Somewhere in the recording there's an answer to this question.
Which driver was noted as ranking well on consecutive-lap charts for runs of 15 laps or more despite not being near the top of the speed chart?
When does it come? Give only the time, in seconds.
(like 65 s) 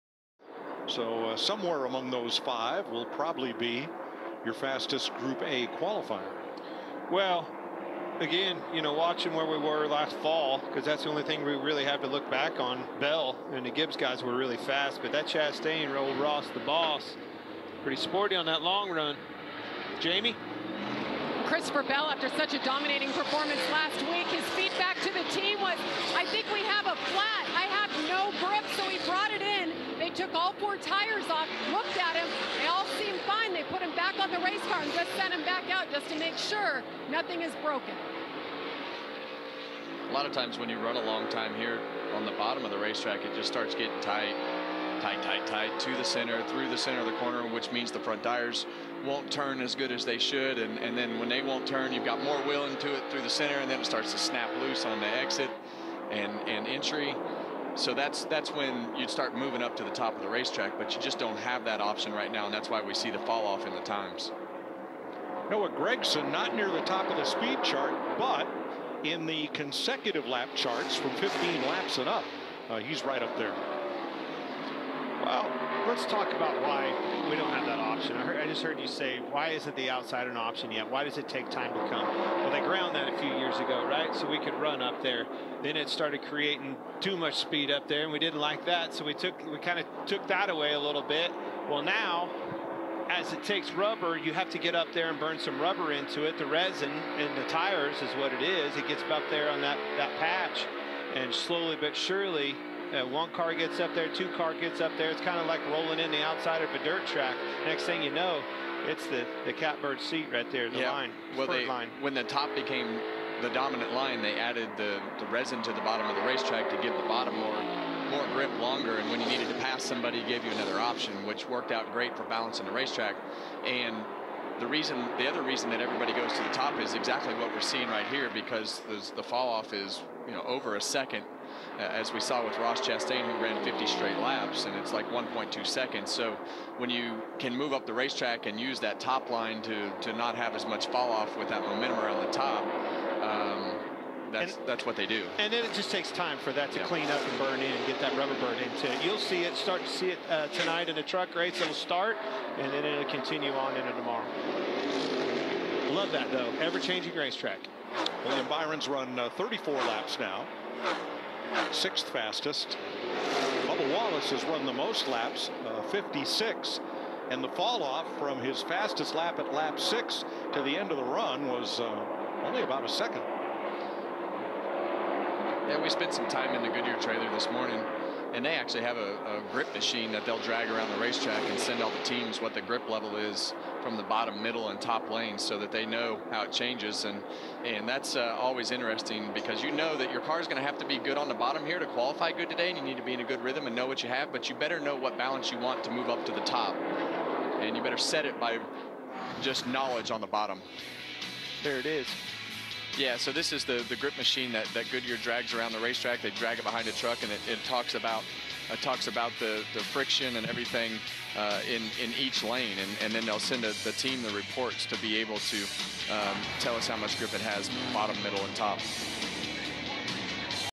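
65 s.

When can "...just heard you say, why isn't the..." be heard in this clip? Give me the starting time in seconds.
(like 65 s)
78 s.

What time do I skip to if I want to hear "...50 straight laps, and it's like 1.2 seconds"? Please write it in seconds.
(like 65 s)
133 s.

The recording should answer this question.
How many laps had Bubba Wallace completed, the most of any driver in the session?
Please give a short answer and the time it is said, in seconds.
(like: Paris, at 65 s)
56, at 165 s.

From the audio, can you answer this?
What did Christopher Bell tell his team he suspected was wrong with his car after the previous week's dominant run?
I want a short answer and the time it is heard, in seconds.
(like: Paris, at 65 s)
A flat, at 26 s.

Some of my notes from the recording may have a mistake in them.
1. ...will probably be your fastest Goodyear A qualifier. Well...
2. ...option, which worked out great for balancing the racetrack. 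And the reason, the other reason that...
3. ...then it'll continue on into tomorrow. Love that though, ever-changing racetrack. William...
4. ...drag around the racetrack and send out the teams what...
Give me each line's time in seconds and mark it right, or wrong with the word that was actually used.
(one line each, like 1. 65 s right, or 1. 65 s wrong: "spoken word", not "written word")
1. 2 s wrong: "Group", not "Goodyear"
2. 120 s right
3. 152 s right
4. 180 s right.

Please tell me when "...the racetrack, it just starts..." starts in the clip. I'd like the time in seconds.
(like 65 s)
42 s.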